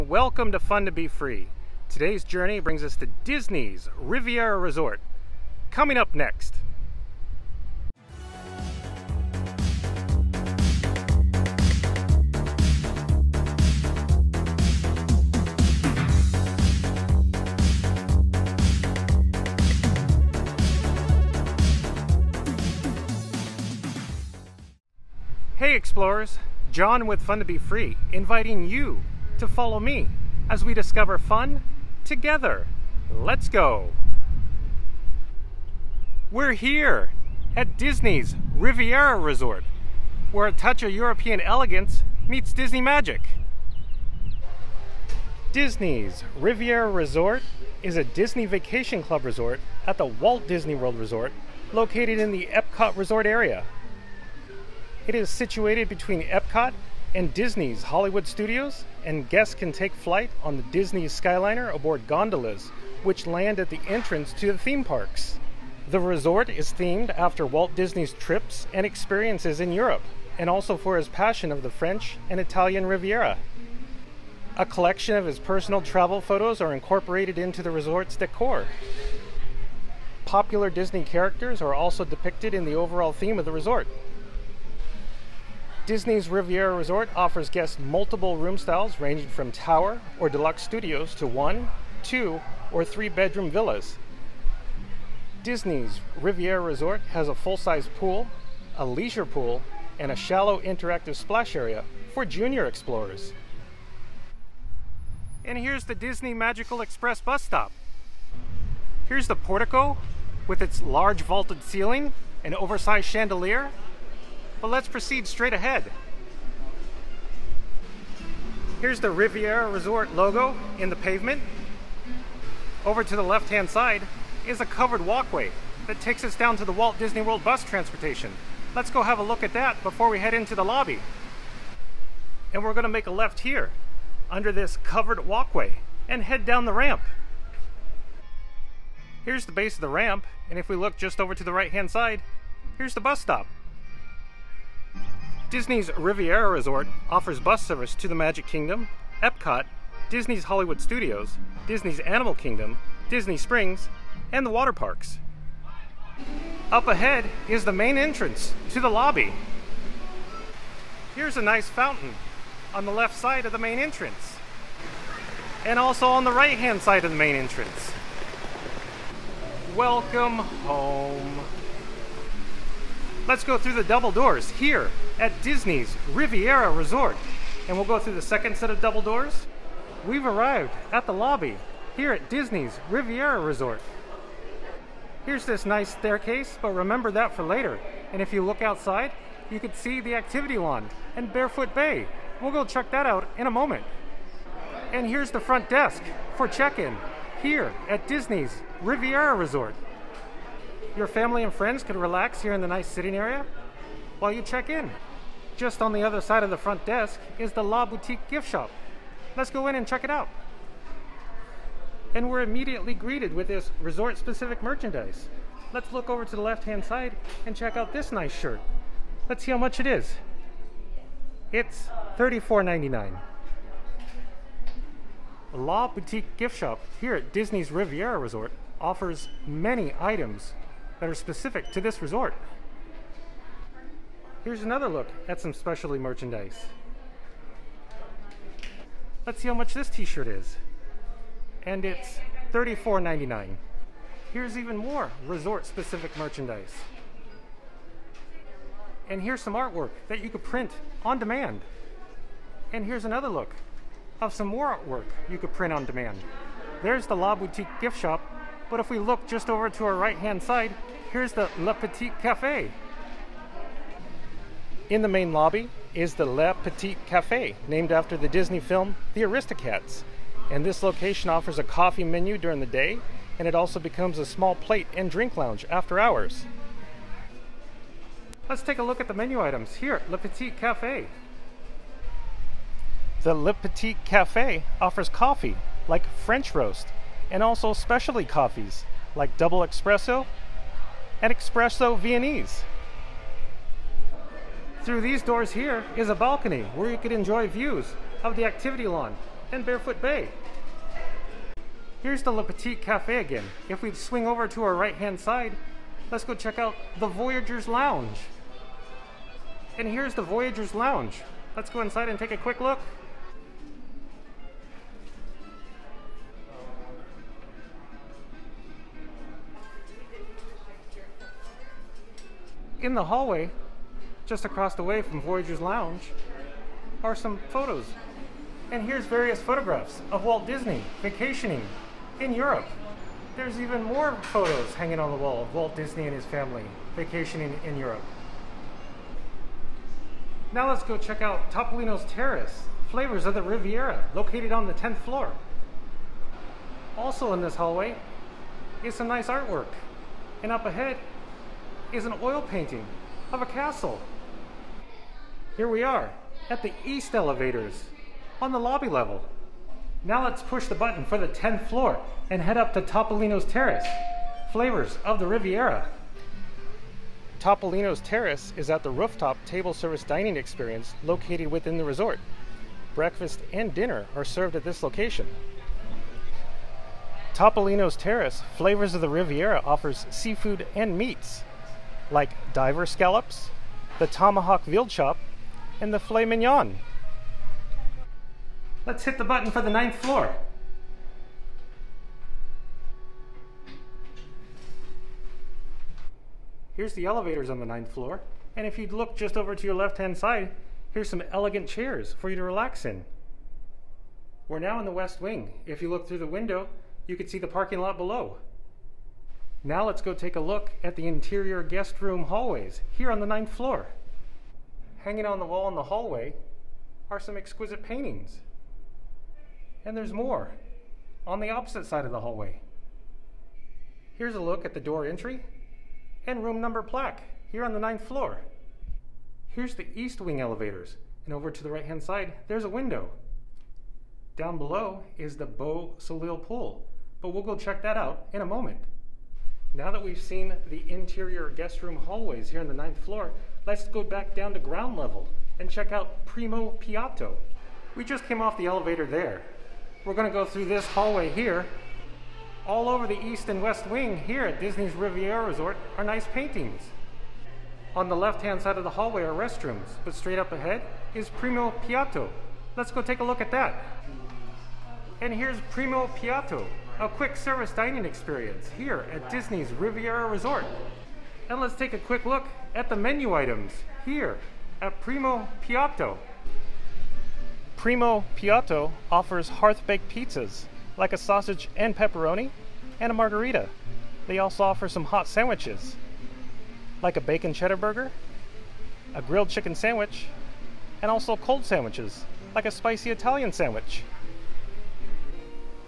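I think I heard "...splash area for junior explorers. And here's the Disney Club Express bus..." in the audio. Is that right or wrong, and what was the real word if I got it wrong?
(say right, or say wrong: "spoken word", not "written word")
wrong: "Magical", not "Club".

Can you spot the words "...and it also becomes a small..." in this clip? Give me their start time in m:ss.
4:33.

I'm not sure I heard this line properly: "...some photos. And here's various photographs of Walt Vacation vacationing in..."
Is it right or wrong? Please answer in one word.
wrong.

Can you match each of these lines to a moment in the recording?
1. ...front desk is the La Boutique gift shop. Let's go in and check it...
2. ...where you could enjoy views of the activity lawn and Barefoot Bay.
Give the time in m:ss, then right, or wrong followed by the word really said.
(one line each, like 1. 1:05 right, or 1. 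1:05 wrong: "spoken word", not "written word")
1. 3:26 right
2. 4:56 right.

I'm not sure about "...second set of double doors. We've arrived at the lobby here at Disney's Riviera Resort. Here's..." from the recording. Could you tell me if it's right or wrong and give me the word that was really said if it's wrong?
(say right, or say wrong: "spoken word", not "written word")
right.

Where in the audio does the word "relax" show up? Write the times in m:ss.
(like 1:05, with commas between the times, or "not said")
3:21, 6:42.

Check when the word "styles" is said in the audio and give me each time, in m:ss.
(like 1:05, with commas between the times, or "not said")
1:28.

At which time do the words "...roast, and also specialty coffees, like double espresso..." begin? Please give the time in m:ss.
4:46.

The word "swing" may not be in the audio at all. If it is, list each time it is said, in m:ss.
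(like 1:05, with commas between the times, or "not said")
5:03.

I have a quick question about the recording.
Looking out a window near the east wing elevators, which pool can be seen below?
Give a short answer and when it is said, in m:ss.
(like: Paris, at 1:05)
Beau Soleil pool, at 7:15.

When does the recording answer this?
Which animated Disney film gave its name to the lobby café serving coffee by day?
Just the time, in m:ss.
4:29.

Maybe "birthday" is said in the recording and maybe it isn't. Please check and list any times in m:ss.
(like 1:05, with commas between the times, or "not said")
not said.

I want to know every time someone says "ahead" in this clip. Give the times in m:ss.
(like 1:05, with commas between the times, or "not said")
1:55, 2:36, 5:50, 7:40.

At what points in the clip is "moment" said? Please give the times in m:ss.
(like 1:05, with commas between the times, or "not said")
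3:13, 7:18.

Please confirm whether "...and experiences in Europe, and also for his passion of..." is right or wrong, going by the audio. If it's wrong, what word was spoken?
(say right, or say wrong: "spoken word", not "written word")
right.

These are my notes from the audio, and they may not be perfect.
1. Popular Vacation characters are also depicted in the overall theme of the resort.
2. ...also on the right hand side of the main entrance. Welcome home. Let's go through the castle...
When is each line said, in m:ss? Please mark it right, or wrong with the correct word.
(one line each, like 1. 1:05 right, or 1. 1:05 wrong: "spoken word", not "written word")
1. 1:20 wrong: "Disney", not "Vacation"
2. 2:45 wrong: "double", not "castle".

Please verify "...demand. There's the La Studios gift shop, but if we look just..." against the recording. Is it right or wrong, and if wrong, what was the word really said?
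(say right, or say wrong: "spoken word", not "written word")
wrong: "Boutique", not "Studios".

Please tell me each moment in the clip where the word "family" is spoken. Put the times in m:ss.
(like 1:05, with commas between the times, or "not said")
3:21, 5:36.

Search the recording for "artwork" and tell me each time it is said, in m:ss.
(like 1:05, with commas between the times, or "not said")
4:09, 4:14, 5:49.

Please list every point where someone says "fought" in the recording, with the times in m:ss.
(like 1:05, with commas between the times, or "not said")
not said.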